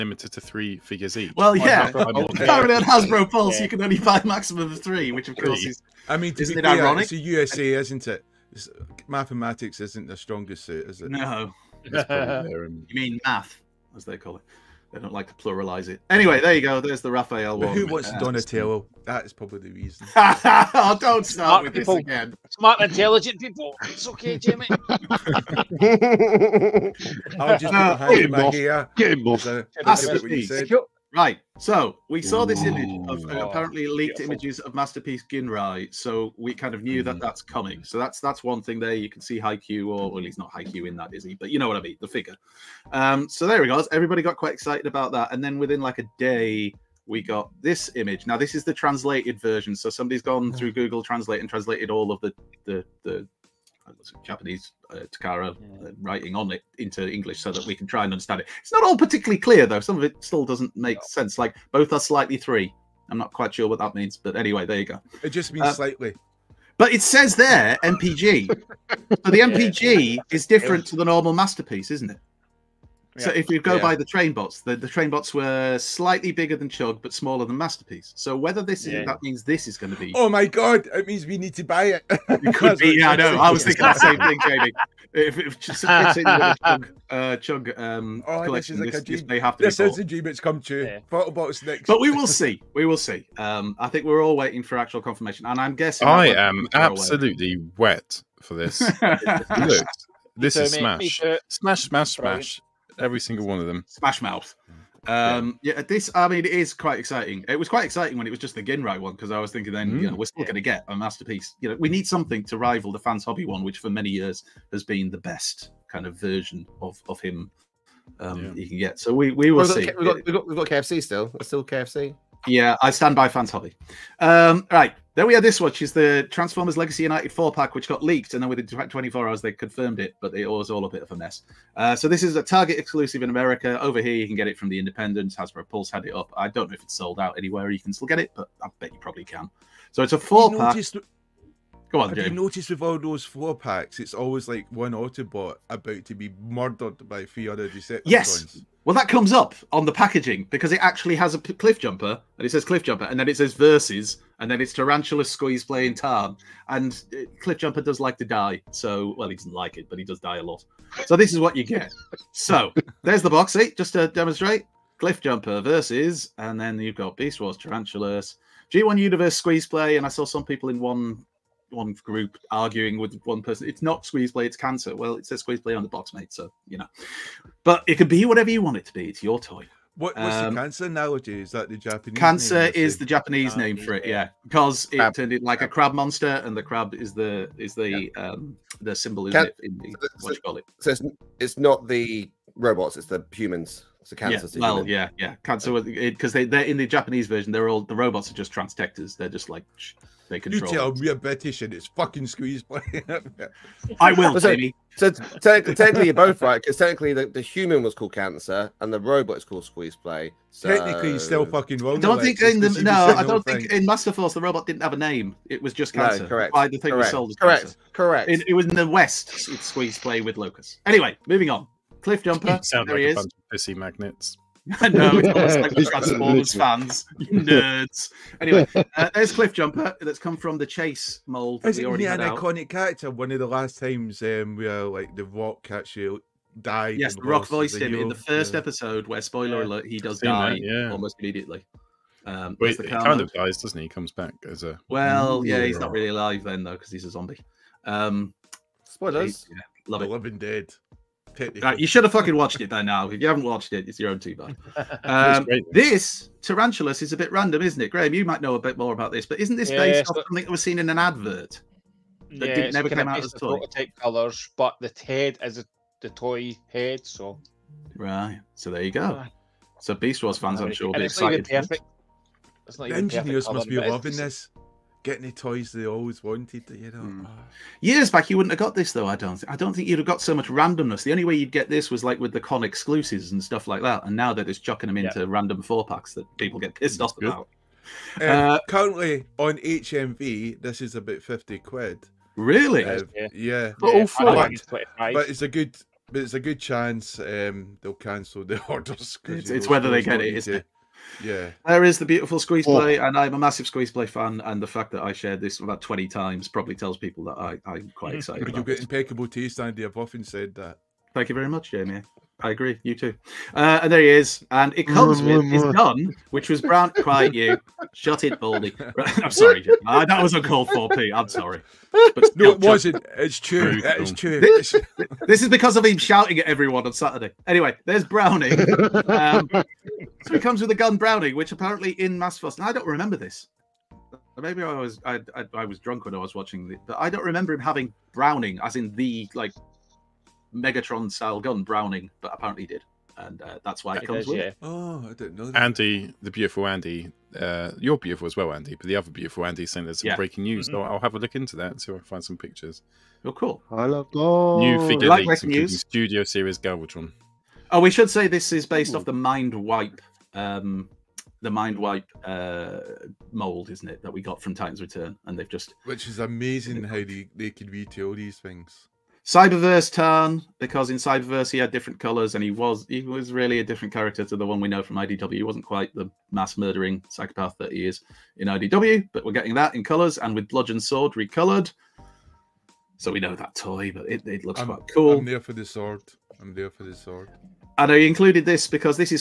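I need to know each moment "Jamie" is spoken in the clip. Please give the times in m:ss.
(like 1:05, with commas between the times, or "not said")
1:24, 5:11.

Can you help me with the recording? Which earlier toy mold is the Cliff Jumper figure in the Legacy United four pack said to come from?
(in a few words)
Chase.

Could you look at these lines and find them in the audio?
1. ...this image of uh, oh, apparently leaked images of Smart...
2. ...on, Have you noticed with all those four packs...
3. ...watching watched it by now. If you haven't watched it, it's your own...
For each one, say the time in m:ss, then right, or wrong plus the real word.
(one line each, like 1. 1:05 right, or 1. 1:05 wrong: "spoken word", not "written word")
1. 0:32 wrong: "Masterpiece", not "Smart"
2. 2:22 right
3. 4:12 wrong: "fucking", not "watching".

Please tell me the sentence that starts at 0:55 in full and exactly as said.
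uh, writing on it into English so that we can try and understand it.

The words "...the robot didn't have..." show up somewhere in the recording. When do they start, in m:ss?
3:34.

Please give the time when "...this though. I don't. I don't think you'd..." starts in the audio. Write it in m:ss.
4:38.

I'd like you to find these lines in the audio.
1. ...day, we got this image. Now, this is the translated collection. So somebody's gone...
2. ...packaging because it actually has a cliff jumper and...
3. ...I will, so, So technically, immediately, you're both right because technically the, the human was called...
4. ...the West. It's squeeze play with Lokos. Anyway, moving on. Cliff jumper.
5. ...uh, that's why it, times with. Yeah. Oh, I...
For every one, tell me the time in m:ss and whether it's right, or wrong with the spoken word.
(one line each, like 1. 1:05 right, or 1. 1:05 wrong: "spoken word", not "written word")
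1. 0:46 wrong: "version", not "collection"
2. 2:29 right
3. 3:24 wrong: "technically", not "immediately"
4. 3:38 right
5. 5:43 wrong: "comes", not "times".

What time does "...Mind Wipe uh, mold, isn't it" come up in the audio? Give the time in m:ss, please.
6:01.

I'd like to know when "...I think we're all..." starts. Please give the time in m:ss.
1:33.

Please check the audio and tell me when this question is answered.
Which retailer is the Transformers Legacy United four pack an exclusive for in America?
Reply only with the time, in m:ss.
2:12.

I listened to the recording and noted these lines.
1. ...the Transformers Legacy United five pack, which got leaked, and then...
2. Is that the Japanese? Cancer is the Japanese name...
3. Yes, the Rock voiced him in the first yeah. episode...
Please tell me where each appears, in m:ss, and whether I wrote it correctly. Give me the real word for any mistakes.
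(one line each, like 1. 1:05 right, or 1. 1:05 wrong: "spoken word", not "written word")
1. 2:05 wrong: "four", not "five"
2. 3:01 right
3. 3:56 right.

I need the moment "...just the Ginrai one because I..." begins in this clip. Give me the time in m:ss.
1:48.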